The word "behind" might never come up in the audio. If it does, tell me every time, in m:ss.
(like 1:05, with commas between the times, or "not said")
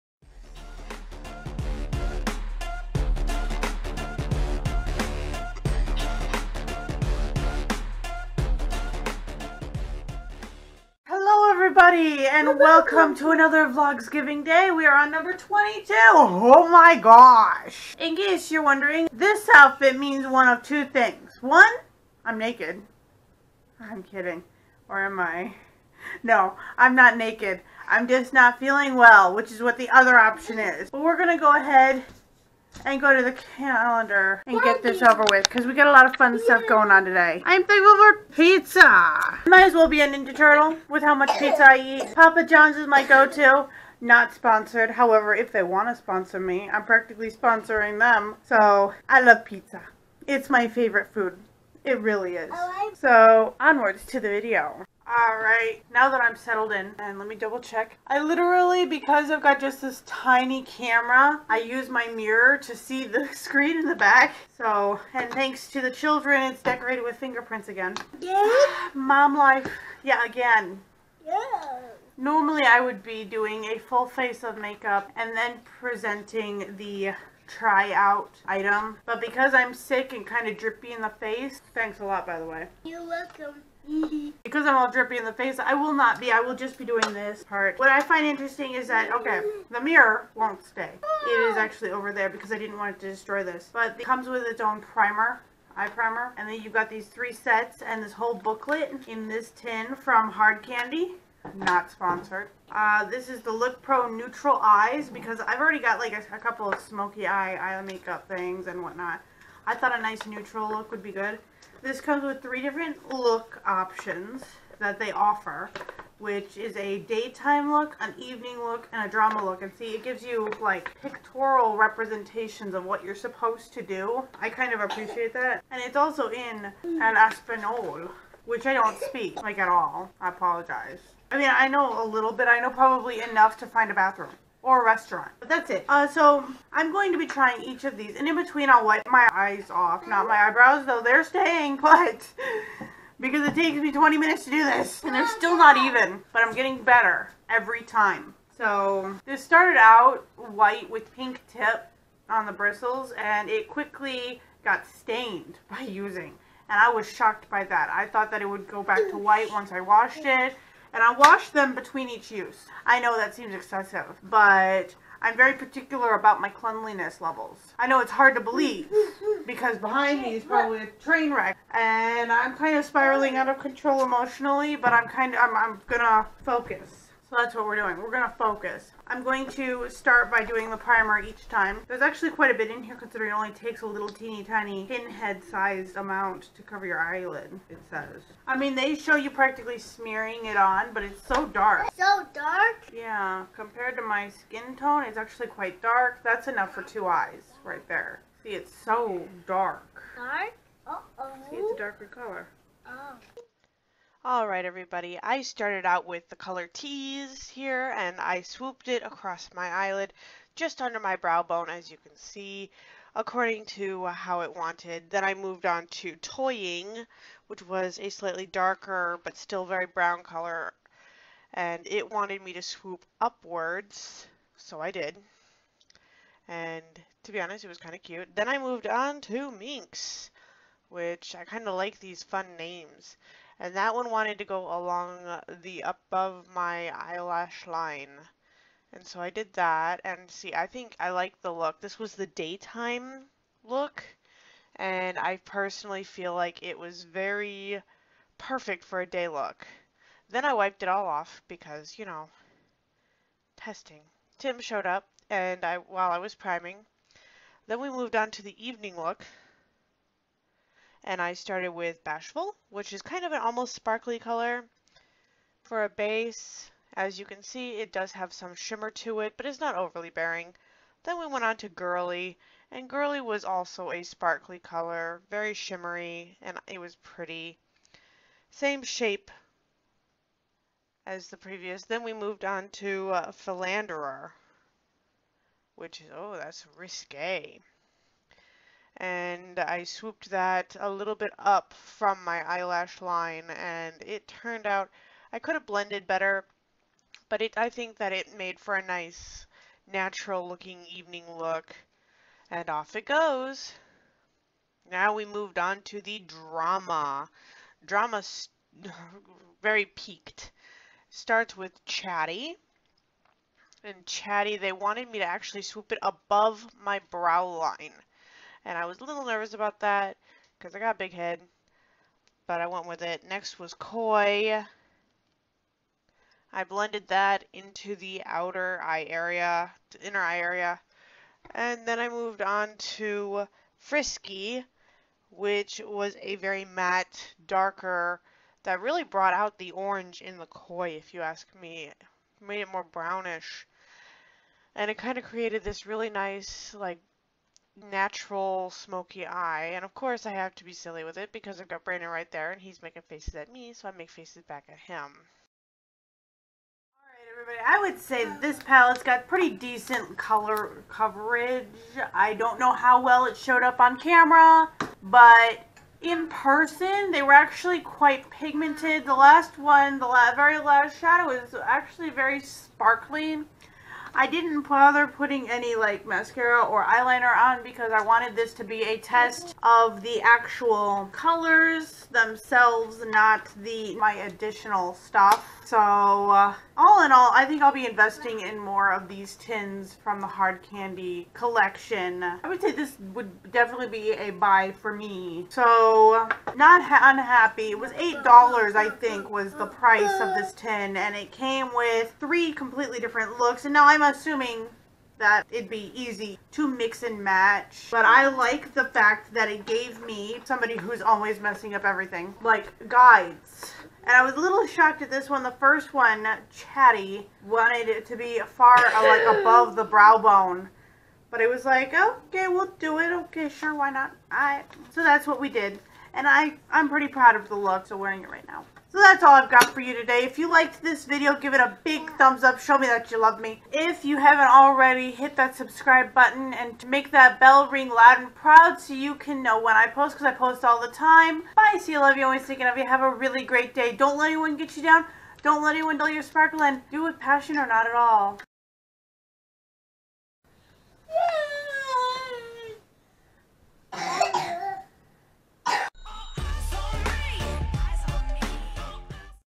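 2:49.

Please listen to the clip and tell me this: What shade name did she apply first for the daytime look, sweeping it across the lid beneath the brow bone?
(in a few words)
Tease.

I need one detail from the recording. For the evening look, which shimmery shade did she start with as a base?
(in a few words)
Bashful.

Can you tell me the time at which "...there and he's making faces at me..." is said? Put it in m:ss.
5:52.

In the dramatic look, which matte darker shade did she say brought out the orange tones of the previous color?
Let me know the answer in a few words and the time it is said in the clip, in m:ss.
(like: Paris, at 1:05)
Frisky, at 5:33.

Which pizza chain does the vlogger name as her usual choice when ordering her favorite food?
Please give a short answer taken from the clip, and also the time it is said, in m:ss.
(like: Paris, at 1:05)
Papa John's, at 0:42.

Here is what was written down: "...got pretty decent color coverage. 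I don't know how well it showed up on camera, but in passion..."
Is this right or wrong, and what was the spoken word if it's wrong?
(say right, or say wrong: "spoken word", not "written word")
wrong: "person", not "passion".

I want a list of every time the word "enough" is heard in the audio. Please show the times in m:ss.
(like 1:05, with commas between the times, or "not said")
2:13, 3:16.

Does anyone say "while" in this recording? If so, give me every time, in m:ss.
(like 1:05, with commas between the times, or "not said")
4:15.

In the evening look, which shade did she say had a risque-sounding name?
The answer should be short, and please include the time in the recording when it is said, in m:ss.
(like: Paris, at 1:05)
Philanderer, at 4:43.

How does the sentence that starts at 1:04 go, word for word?
So, and thanks to the children, it's decorated with fingerprints again.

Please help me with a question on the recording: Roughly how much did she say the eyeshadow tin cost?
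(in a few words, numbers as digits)
$8.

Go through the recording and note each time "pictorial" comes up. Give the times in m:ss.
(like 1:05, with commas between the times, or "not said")
2:01.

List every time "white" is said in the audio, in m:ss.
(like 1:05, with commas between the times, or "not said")
2:30, 2:39.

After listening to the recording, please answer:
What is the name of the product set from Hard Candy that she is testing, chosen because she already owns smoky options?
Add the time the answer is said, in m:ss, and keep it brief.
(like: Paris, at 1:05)
Look Pro Neutral Eyes, at 1:43.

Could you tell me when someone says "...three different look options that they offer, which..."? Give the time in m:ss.
1:52.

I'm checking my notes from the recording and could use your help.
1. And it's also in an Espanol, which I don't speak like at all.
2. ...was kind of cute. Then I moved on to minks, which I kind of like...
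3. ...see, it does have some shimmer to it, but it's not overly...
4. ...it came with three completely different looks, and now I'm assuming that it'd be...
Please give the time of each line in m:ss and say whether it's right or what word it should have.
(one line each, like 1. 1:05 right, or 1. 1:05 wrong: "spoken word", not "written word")
1. 2:05 right
2. 3:47 right
3. 4:27 right
4. 6:41 right.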